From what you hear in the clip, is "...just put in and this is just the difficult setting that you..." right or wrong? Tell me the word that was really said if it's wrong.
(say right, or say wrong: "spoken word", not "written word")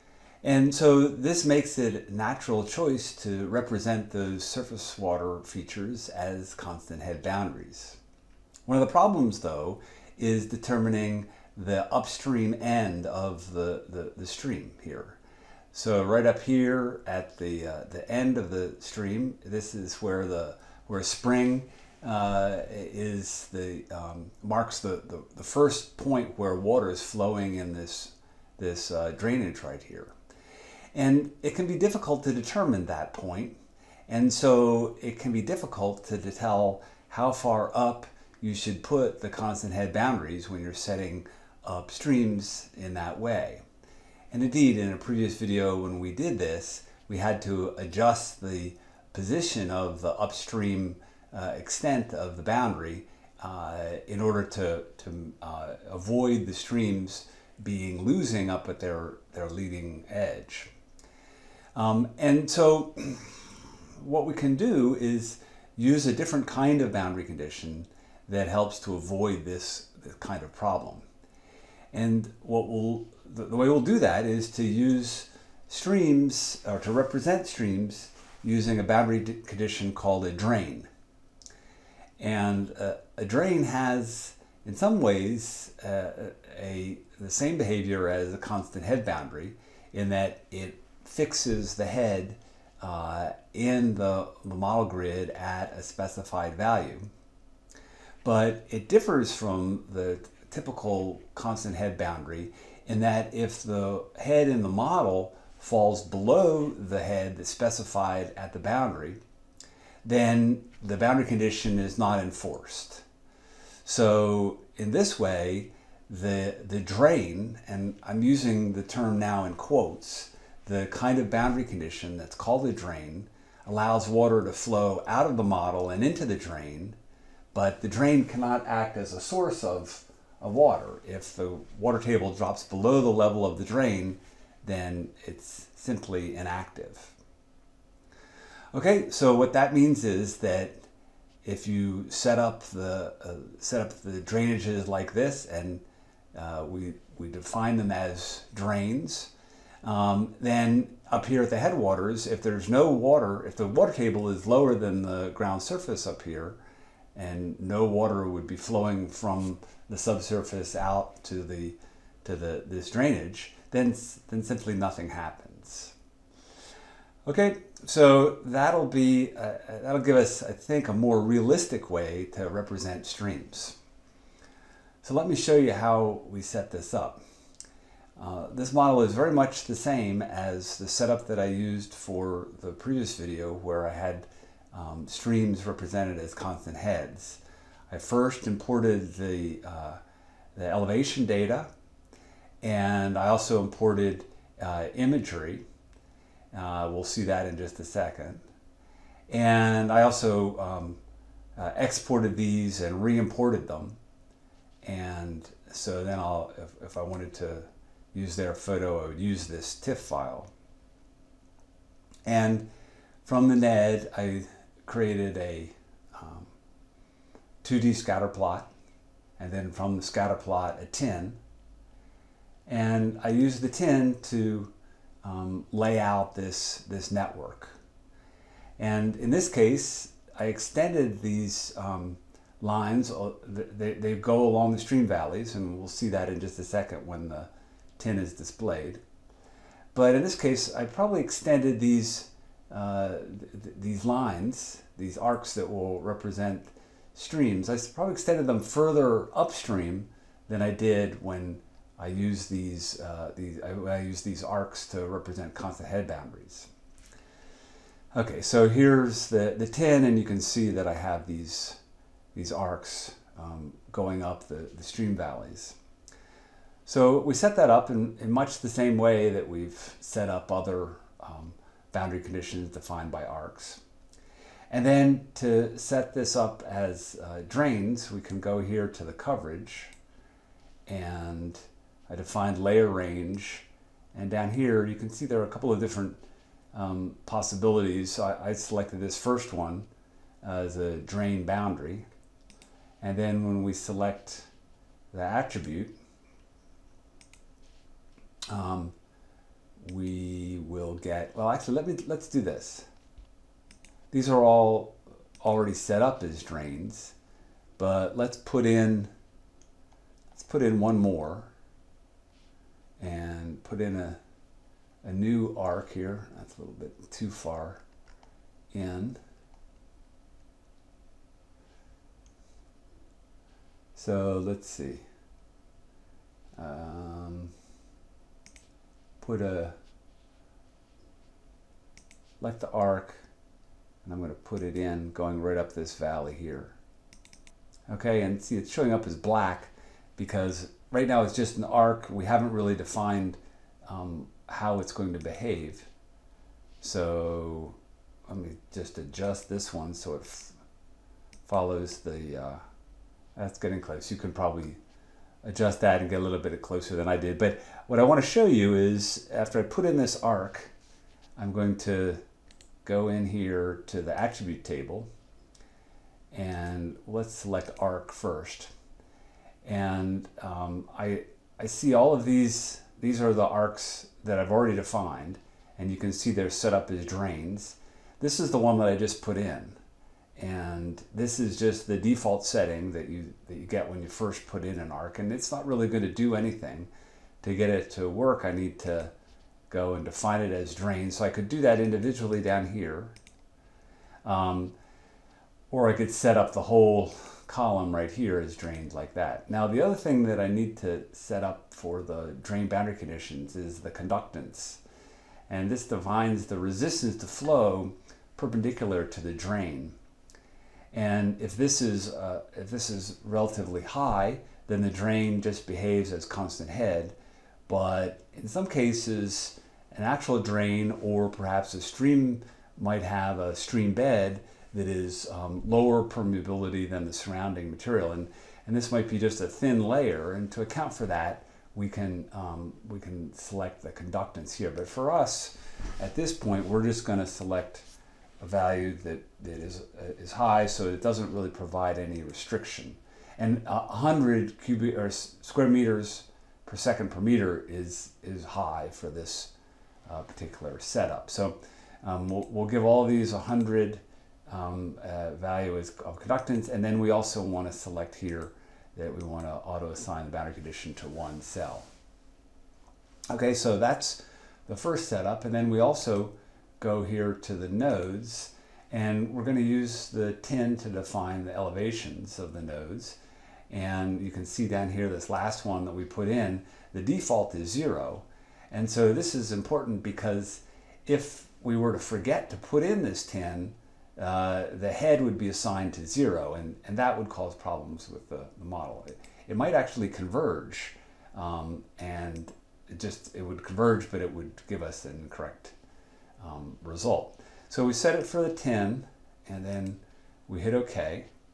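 wrong: "default", not "difficult".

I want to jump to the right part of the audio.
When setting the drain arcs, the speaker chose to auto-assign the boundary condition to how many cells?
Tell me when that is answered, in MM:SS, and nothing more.
07:41.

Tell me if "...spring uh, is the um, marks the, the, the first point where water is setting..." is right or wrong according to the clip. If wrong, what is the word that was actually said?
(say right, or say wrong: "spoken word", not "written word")
wrong: "flowing", not "setting".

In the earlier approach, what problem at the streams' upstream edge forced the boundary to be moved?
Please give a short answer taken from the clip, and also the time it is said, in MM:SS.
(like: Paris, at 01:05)
streams being losing, at 00:56.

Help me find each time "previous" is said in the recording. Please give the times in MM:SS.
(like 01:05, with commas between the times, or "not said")
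00:44, 03:02.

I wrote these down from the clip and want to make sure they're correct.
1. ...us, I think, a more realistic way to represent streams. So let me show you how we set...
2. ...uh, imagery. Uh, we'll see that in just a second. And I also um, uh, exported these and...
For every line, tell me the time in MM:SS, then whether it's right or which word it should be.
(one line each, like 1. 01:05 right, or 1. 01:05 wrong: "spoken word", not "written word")
1. 02:50 right
2. 03:14 right.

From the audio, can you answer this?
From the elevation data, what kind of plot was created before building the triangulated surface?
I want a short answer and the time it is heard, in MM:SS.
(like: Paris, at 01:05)
2D scatter plot, at 03:37.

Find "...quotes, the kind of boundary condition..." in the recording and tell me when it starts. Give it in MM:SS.
01:59.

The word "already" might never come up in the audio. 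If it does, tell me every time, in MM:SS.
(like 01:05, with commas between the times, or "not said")
05:05, 06:14.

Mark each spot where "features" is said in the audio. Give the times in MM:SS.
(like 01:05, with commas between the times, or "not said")
00:05.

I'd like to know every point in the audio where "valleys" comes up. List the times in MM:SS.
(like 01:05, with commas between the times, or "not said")
03:55, 04:25, 05:35.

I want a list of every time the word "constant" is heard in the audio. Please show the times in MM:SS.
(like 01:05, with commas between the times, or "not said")
00:06, 00:39, 01:28, 01:41, 03:06, 04:15, 06:56.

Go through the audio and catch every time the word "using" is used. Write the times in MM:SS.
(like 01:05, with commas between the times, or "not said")
01:18, 01:58.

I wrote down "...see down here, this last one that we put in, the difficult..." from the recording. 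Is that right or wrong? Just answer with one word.
wrong.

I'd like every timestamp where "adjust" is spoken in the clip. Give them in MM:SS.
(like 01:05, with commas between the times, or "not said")
00:47, 05:48, 05:55.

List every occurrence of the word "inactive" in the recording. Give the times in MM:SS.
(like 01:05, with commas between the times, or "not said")
02:16.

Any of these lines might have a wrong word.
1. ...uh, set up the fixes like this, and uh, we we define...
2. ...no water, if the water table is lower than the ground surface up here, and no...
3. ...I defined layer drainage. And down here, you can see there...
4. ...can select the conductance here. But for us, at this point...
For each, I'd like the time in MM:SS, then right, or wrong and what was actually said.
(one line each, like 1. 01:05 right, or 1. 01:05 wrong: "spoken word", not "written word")
1. 02:23 wrong: "drainages", not "fixes"
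2. 02:32 right
3. 04:42 wrong: "range", not "drainage"
4. 07:13 right.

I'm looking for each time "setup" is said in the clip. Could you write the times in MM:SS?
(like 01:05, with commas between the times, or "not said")
03:00, 07:30, 07:45.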